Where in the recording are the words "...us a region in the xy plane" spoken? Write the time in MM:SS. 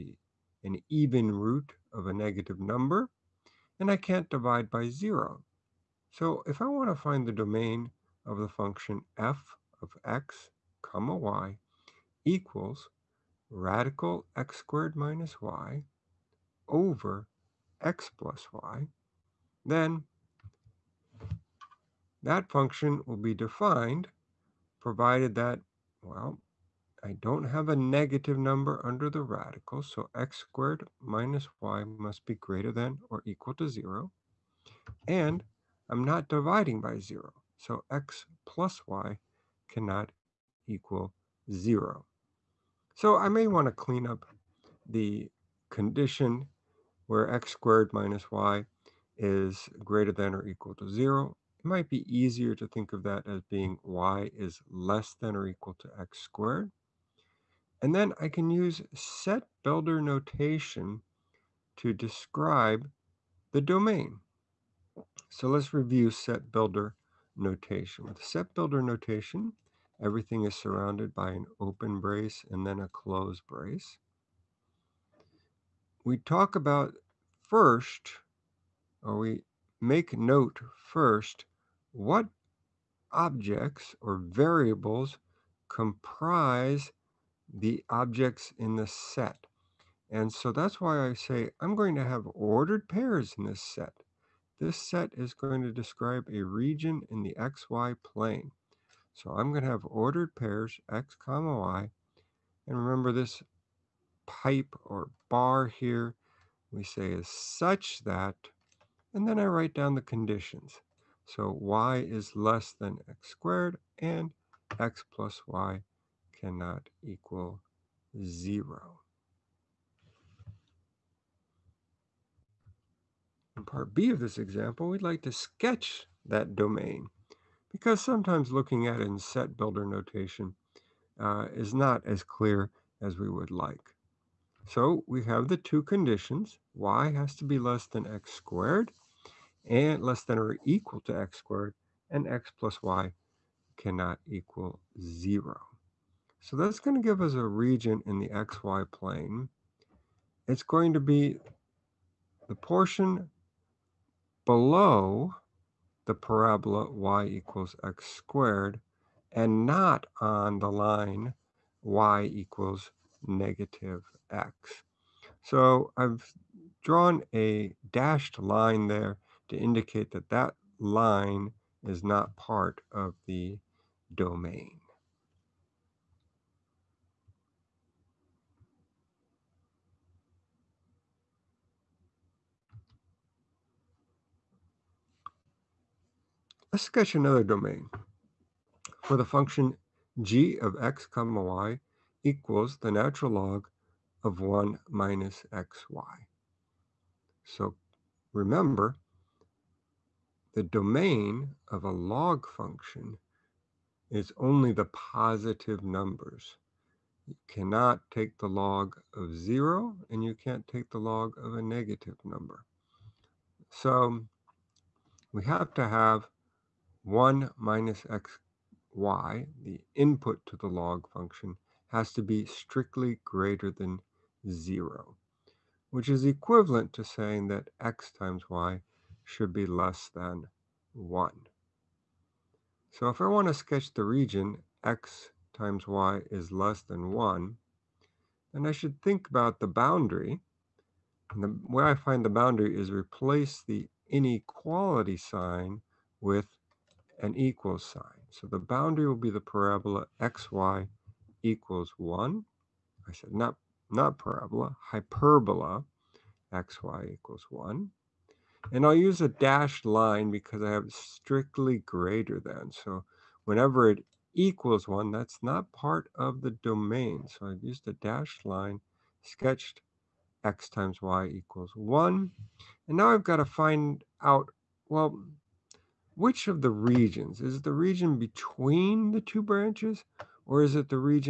02:27.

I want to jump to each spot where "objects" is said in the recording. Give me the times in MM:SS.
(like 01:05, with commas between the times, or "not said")
01:23, 01:27.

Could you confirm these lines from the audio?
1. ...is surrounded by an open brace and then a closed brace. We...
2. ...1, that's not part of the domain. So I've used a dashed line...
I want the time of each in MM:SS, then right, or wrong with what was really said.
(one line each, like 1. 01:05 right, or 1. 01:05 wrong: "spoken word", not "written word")
1. 01:10 right
2. 04:24 right.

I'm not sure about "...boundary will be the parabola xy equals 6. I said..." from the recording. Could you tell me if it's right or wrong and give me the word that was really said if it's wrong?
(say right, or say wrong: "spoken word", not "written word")
wrong: "1", not "6".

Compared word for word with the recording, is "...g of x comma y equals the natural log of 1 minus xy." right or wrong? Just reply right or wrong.
right.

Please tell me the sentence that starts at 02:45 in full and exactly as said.
So I've drawn a dashed line there to indicate that that line is not part of the domain.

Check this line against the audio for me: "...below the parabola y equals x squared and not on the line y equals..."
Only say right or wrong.
right.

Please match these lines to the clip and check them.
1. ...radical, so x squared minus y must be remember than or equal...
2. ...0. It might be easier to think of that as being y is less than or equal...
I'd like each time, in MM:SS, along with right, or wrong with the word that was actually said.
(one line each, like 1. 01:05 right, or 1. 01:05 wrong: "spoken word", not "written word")
1. 00:29 wrong: "greater", not "remember"
2. 00:50 right.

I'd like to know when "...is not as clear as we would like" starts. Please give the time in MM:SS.
02:11.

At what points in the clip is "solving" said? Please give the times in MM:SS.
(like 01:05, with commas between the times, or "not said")
not said.